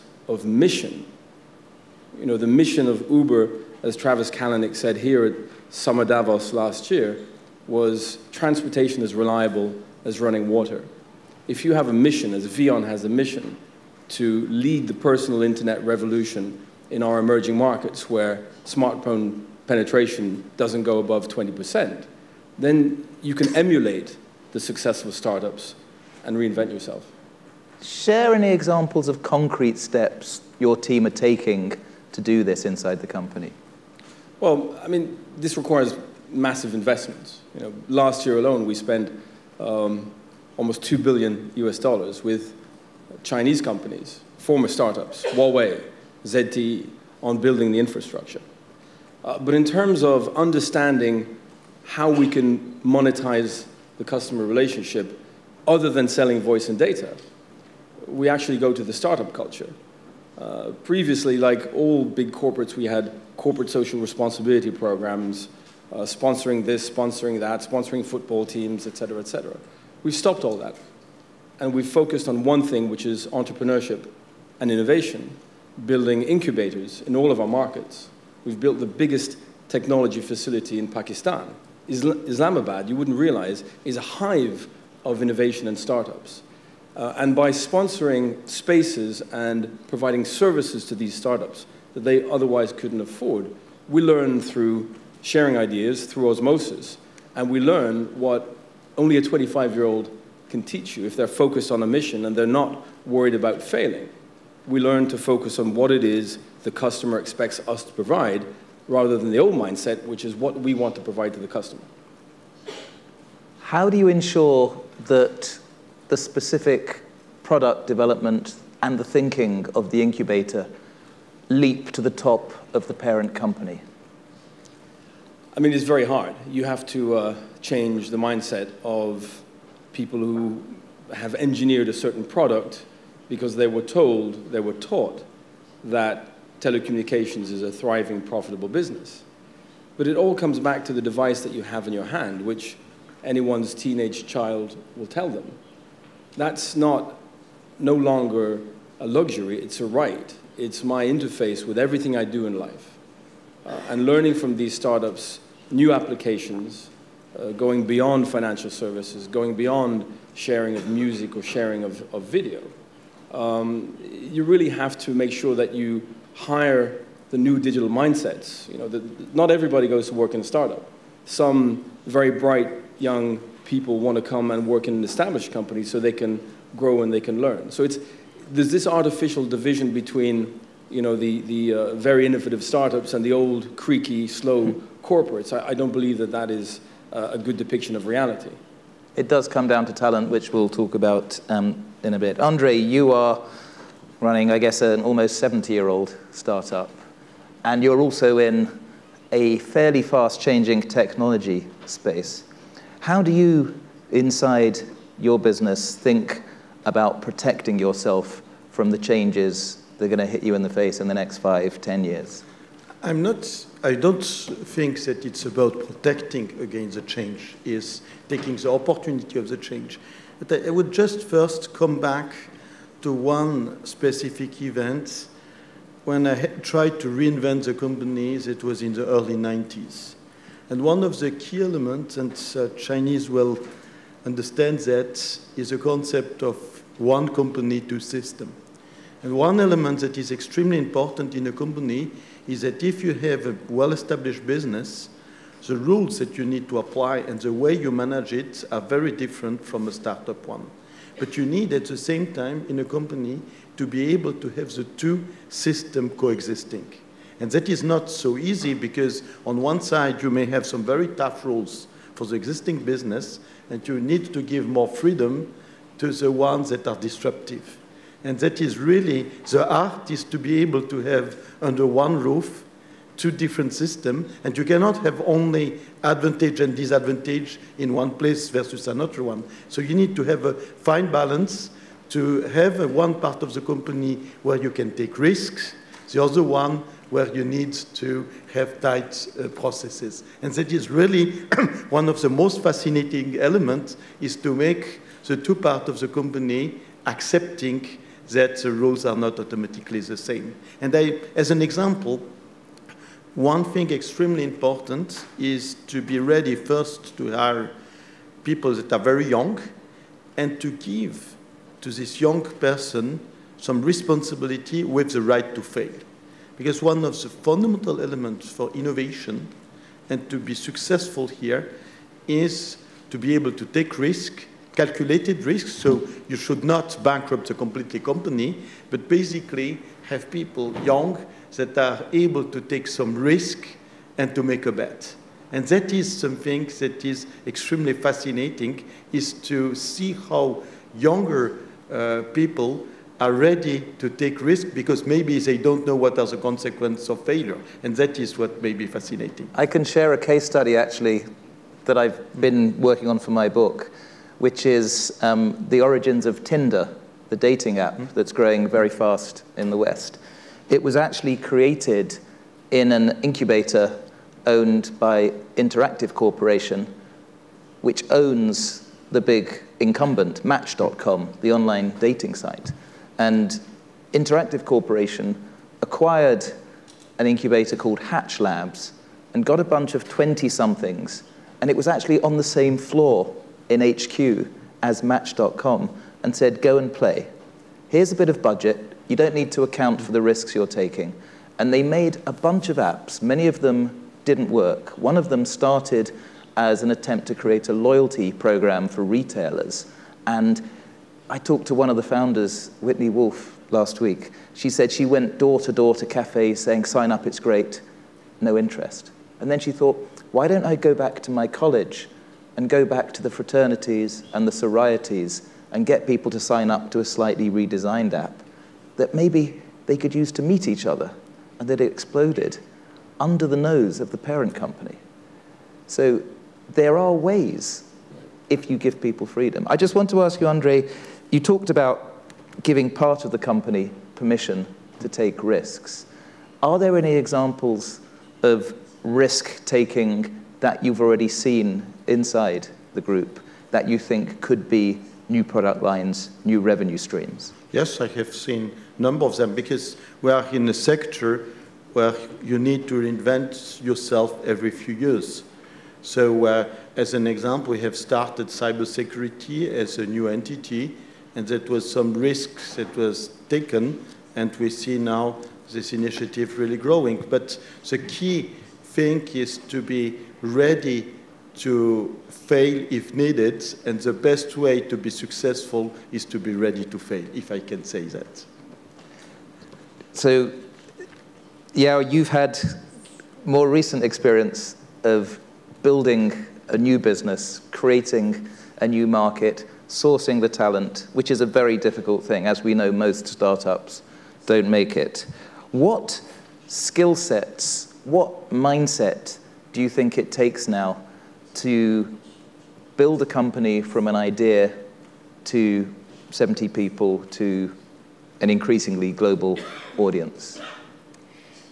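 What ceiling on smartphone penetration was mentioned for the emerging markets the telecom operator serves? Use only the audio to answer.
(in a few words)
20%.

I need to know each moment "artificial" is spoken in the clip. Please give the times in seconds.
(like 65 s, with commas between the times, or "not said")
178 s.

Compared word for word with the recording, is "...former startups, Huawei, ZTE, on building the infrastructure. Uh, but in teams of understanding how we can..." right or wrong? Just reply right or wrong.
wrong.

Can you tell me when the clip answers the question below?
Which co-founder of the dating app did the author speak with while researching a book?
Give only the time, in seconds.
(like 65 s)
402 s.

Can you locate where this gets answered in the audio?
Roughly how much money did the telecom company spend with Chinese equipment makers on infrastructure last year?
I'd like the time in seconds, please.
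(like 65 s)
40 s.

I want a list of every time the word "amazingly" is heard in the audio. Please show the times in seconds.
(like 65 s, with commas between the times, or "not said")
not said.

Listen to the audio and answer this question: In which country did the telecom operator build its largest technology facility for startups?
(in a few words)
Pakistan.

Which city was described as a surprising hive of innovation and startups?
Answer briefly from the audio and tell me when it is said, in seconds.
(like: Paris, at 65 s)
Islamabad, at 81 s.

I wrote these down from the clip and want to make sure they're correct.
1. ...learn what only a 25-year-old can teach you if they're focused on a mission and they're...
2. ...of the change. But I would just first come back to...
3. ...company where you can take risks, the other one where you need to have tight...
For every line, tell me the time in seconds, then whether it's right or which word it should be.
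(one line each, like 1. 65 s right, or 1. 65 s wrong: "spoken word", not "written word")
1. 97 s right
2. 219 s right
3. 283 s right.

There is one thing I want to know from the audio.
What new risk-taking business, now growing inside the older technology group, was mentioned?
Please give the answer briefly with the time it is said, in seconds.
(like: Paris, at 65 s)
cybersecurity, at 458 s.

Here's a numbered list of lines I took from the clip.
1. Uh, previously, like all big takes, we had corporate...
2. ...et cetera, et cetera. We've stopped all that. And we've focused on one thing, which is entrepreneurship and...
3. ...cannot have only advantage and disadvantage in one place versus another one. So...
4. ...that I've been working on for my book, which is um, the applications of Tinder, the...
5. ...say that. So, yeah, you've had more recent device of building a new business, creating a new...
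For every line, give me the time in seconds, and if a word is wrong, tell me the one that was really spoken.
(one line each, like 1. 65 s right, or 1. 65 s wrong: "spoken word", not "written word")
1. 60 s wrong: "corporates", not "takes"
2. 68 s right
3. 274 s right
4. 351 s wrong: "origins", not "applications"
5. 477 s wrong: "experience", not "device".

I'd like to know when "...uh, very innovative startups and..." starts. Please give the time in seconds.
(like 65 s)
181 s.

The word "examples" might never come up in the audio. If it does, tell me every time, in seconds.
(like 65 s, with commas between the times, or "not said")
28 s, 301 s, 437 s, 457 s.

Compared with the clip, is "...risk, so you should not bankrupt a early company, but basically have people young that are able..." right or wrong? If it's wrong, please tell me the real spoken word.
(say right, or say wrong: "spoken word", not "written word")
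wrong: "completely", not "early".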